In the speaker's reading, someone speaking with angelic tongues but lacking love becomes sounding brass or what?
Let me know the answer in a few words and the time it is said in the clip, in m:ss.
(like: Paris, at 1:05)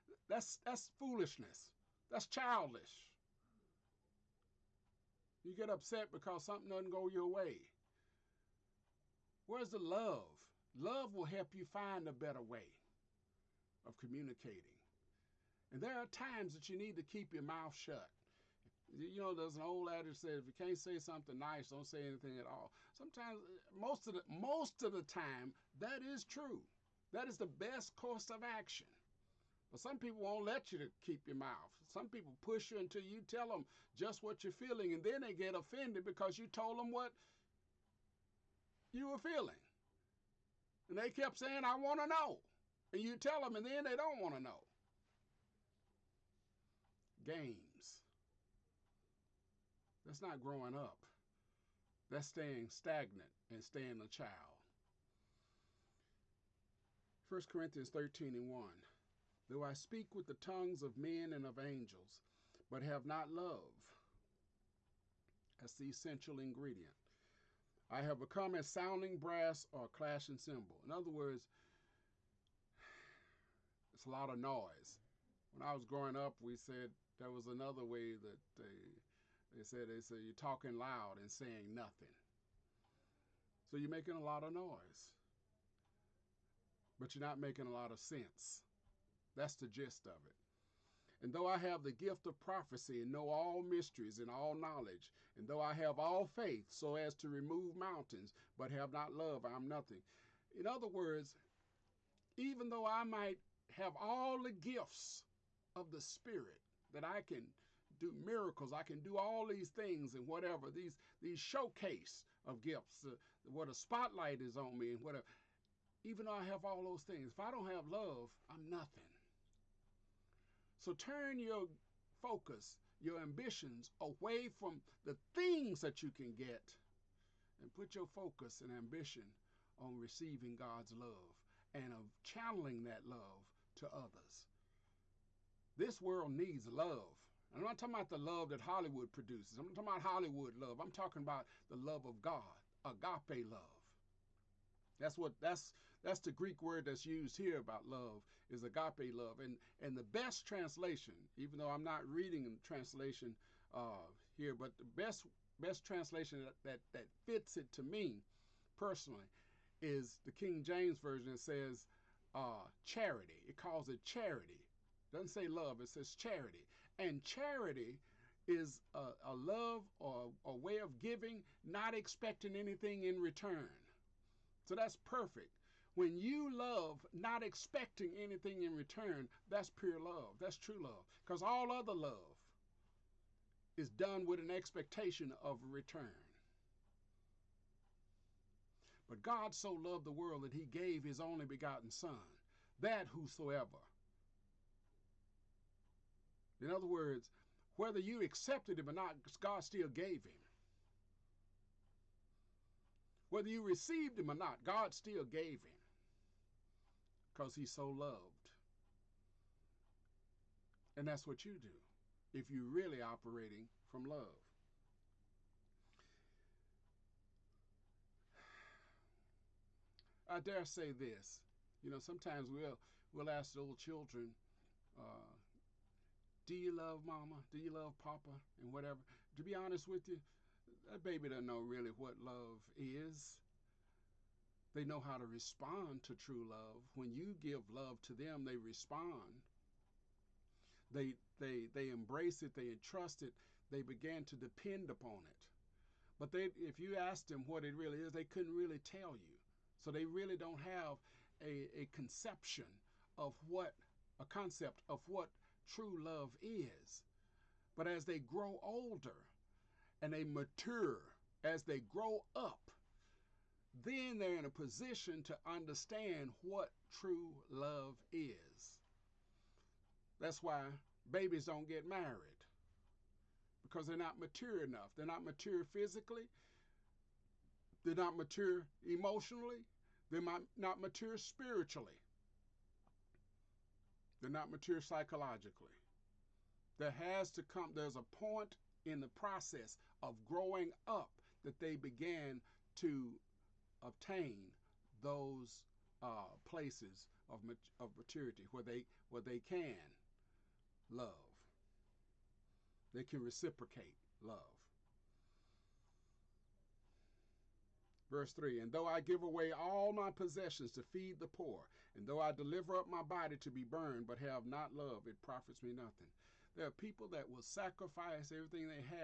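clashing cymbal, at 1:09.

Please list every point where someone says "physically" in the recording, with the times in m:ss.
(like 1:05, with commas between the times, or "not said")
4:35.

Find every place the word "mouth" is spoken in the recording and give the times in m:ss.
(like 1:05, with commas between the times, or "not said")
0:17, 0:31.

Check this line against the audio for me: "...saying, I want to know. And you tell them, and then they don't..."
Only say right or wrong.
right.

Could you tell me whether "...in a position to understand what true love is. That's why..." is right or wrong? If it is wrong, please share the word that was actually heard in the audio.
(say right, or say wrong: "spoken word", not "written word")
right.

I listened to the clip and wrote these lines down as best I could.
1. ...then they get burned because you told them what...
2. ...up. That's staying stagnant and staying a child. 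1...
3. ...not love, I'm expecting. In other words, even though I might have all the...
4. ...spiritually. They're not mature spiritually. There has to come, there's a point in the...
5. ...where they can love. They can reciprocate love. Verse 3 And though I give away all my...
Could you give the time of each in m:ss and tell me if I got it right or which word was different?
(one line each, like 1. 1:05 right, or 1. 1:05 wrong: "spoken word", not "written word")
1. 0:35 wrong: "offended", not "burned"
2. 0:50 right
3. 1:38 wrong: "nothing", not "expecting"
4. 4:41 wrong: "psychologically", not "spiritually"
5. 4:59 right.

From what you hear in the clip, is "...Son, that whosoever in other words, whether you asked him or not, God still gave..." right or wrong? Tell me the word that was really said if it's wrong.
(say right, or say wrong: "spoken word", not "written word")
wrong: "accepted", not "asked".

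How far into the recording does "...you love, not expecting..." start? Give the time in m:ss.
2:56.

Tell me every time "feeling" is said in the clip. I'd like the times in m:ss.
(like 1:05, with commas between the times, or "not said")
0:34, 0:39.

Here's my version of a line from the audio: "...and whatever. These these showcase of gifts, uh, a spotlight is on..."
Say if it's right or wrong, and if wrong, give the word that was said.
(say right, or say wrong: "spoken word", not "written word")
right.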